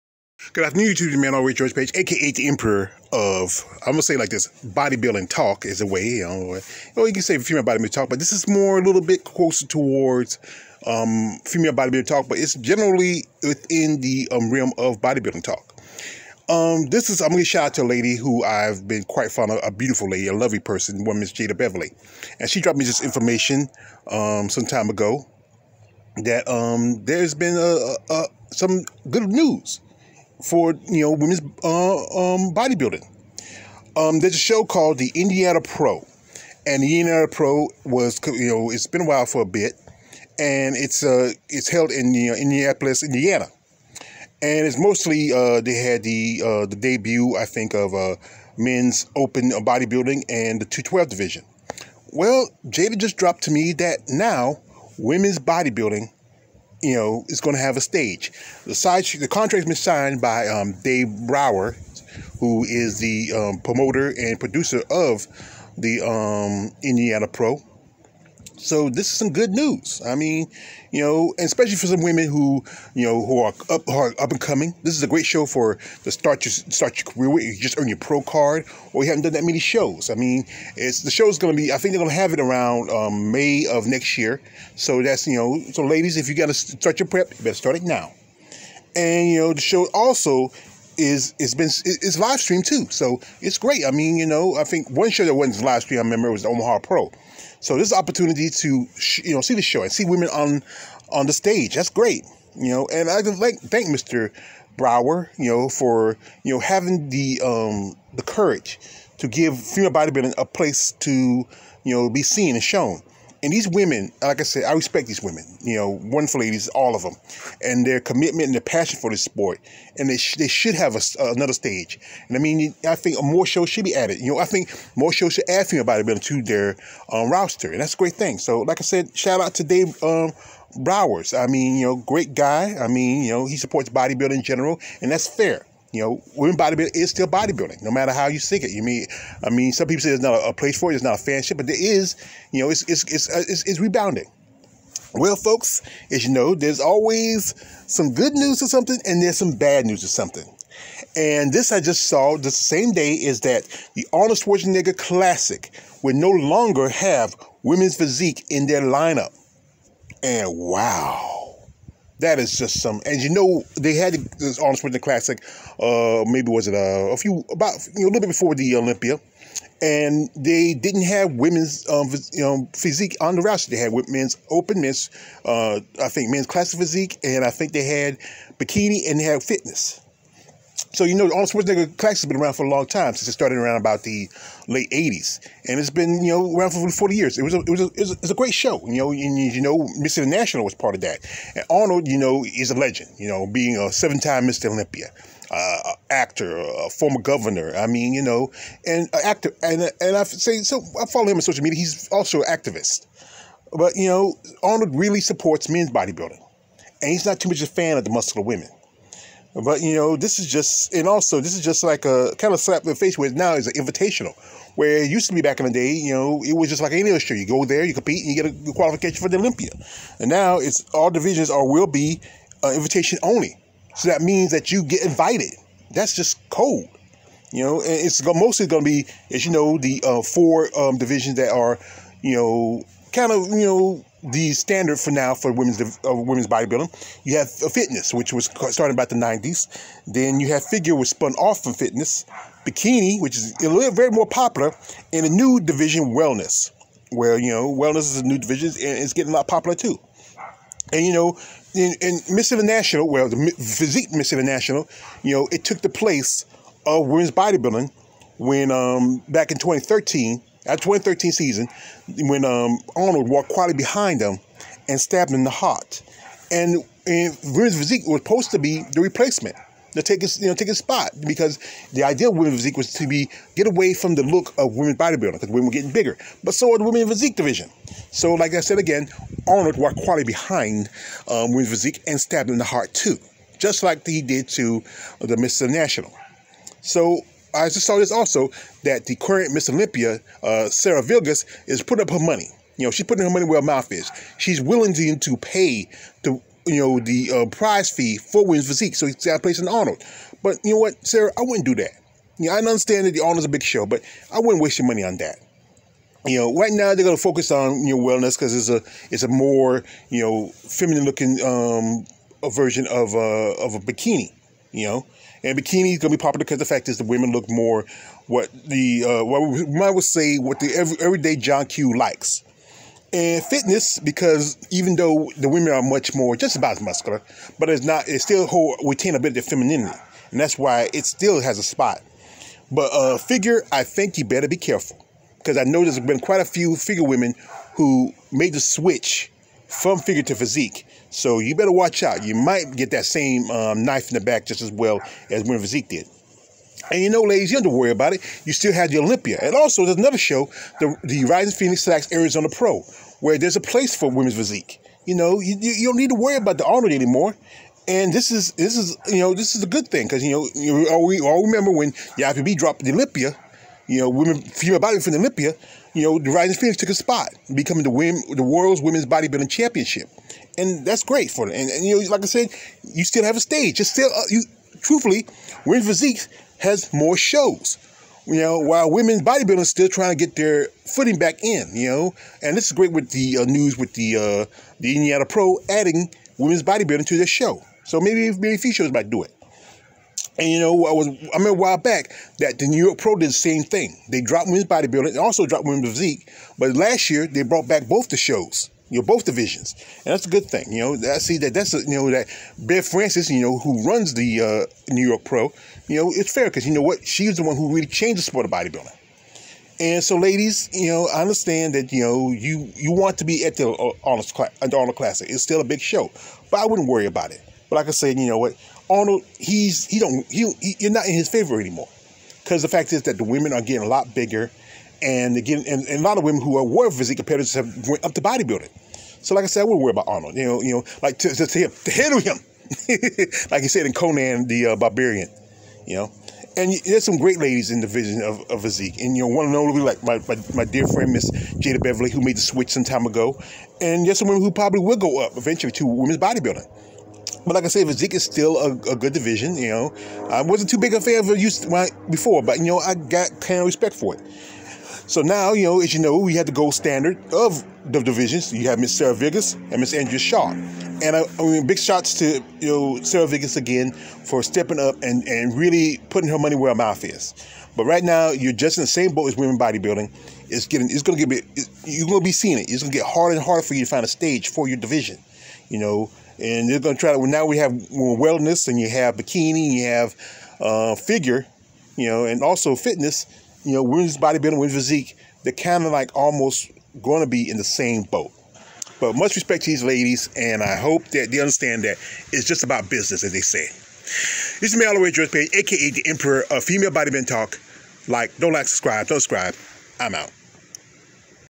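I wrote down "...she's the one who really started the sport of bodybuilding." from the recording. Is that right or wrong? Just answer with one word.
wrong.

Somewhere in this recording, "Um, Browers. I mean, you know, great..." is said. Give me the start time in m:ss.
2:10.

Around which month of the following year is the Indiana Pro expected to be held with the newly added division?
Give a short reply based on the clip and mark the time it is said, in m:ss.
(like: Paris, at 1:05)
May, at 1:23.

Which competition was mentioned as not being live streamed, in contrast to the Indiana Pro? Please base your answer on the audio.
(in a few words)
Omaha Pro.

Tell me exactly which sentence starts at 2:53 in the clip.
They had men's open, men's uh, I think men's classic physique, and I think they had bikini and they had fitness.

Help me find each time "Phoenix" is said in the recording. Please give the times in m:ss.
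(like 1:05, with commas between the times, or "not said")
5:51, 6:06.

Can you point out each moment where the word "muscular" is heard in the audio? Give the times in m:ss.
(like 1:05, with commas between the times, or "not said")
3:28, 5:26.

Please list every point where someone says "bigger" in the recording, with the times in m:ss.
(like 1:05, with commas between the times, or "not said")
4:35, 7:04.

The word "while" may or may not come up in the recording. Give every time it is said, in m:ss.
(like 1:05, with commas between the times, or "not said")
0:39, 6:18, 6:31.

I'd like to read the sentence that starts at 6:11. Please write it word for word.
And, and, you know, like I said, you still have a stage.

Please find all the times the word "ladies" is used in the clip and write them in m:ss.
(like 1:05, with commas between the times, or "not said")
1:25, 1:56, 5:47, 6:50, 7:17, 8:09.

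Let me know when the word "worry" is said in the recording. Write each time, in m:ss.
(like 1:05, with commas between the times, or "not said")
5:47, 5:56, 6:56, 7:09.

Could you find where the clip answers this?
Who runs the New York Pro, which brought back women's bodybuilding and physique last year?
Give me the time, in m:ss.
6:42.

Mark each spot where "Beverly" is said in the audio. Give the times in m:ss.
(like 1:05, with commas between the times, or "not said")
0:21, 7:21.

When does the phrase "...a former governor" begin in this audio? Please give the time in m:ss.
3:16.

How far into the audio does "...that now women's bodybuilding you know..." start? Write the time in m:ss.
0:53.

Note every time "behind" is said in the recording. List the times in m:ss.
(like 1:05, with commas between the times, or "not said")
4:23, 4:40.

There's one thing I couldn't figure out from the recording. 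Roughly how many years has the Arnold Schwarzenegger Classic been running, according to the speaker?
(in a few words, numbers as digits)
40 years.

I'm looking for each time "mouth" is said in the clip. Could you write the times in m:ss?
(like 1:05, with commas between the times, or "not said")
4:53, 7:46.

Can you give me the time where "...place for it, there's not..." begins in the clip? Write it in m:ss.
2:20.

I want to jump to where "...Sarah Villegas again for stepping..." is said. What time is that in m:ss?
7:43.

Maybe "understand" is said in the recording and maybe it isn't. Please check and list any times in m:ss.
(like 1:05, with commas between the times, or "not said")
5:02, 6:51, 8:11.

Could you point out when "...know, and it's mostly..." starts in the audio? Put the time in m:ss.
3:47.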